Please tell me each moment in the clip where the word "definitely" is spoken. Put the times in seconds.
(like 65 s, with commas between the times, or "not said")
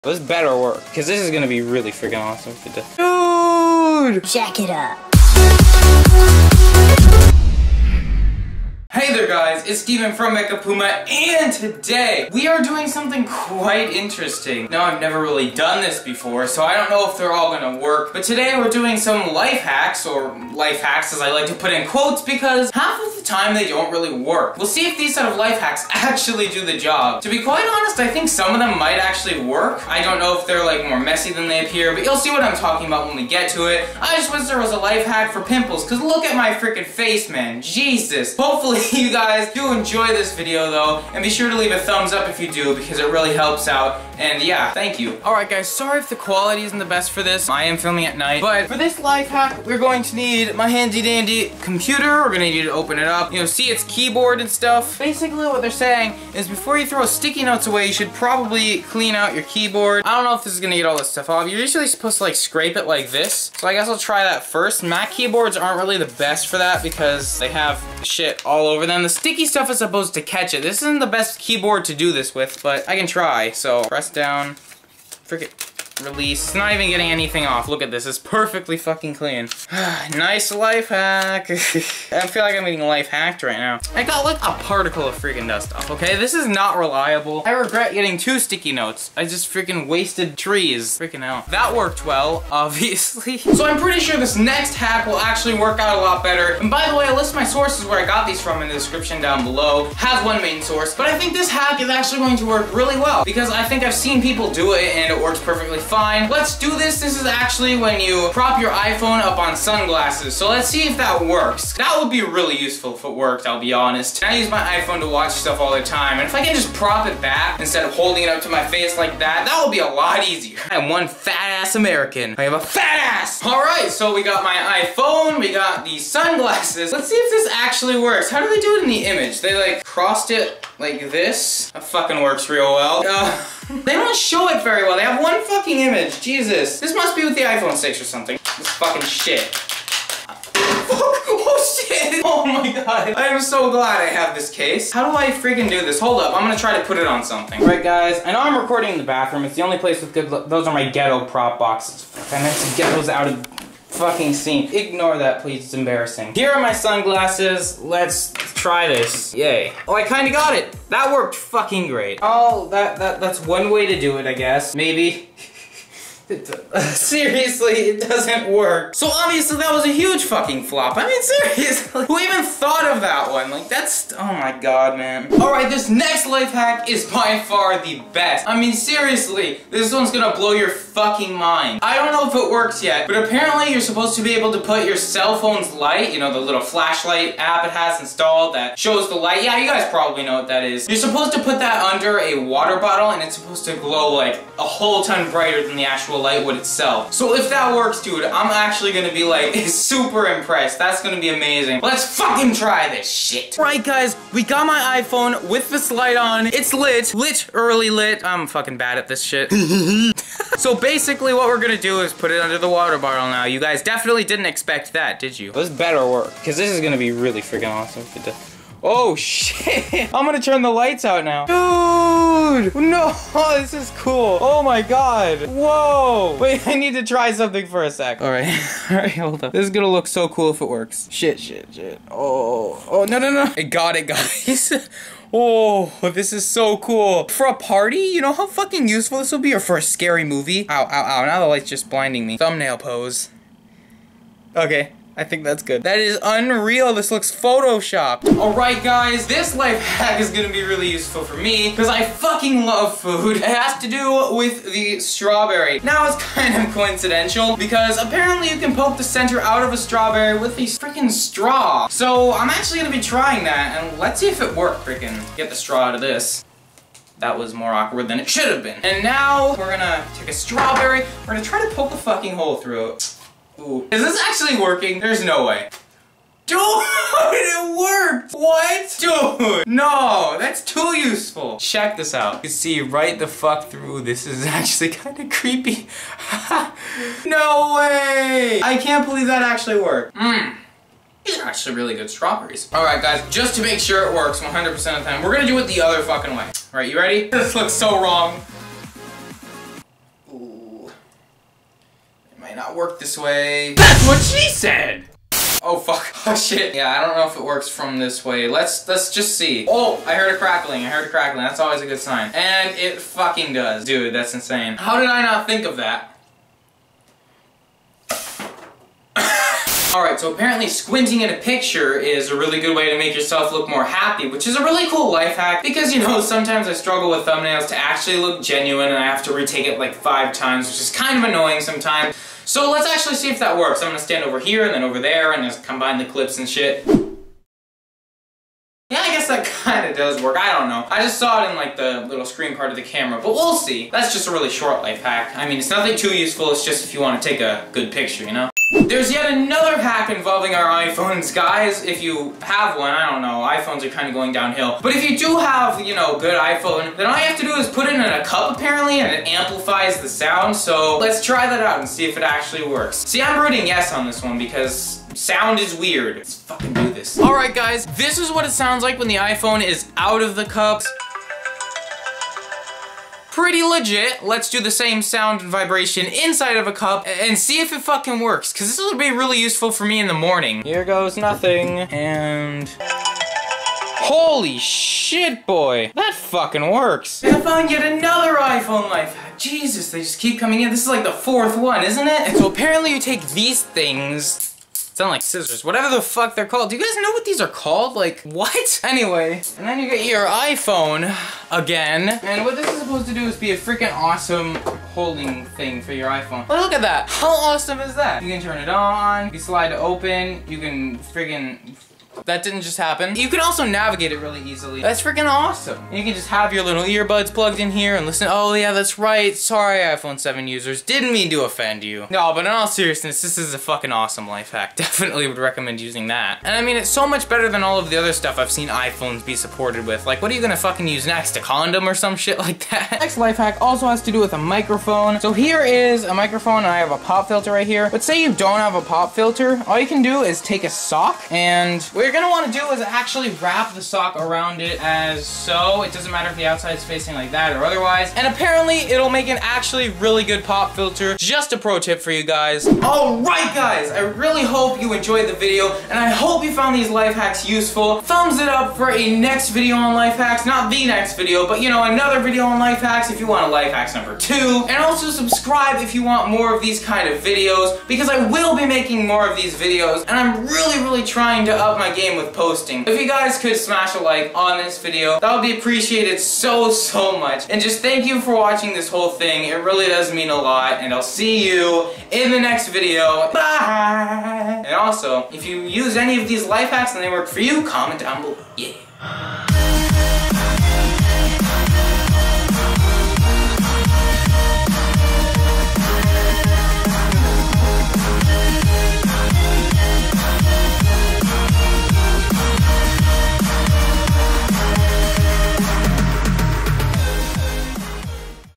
213 s, 424 s.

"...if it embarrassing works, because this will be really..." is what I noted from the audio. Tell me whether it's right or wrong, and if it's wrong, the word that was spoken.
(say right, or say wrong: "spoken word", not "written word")
wrong: "fucking", not "embarrassing".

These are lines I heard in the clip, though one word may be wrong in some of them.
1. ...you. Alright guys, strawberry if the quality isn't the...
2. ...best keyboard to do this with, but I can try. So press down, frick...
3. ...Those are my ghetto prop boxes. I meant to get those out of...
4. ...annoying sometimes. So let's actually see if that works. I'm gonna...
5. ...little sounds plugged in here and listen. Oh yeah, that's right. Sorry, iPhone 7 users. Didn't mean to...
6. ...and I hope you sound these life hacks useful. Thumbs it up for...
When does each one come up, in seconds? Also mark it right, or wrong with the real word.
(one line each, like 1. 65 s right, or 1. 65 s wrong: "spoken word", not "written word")
1. 44 s wrong: "sorry", not "strawberry"
2. 71 s right
3. 150 s right
4. 331 s right
5. 416 s wrong: "earbuds", not "sounds"
6. 455 s wrong: "found", not "sound".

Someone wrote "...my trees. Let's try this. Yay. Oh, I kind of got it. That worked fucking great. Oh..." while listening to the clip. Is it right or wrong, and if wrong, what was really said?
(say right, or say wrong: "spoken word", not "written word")
wrong: "sunglasses", not "trees".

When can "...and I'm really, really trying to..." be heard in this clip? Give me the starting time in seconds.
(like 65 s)
470 s.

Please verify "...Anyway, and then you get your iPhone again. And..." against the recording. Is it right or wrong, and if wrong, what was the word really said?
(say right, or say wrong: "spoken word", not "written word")
right.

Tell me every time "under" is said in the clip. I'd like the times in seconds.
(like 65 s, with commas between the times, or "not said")
191 s, 212 s.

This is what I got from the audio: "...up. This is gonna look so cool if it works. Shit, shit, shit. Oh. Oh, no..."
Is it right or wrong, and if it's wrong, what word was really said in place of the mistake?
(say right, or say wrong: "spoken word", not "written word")
right.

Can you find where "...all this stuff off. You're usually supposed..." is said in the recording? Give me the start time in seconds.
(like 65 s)
60 s.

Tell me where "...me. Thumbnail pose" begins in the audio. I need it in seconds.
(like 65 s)
242 s.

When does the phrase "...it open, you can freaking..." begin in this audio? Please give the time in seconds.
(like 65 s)
409 s.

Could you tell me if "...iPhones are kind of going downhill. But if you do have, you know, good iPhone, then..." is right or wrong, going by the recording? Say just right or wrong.
right.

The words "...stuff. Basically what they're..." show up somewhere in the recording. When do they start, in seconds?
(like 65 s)
54 s.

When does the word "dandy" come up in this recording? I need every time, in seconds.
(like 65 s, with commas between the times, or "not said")
51 s.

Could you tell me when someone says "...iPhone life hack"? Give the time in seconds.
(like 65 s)
388 s.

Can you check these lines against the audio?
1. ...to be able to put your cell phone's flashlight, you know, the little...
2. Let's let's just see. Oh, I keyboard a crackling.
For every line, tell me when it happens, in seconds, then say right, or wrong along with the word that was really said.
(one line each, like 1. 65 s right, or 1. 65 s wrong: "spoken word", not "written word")
1. 184 s wrong: "light", not "flashlight"
2. 308 s wrong: "heard", not "keyboard".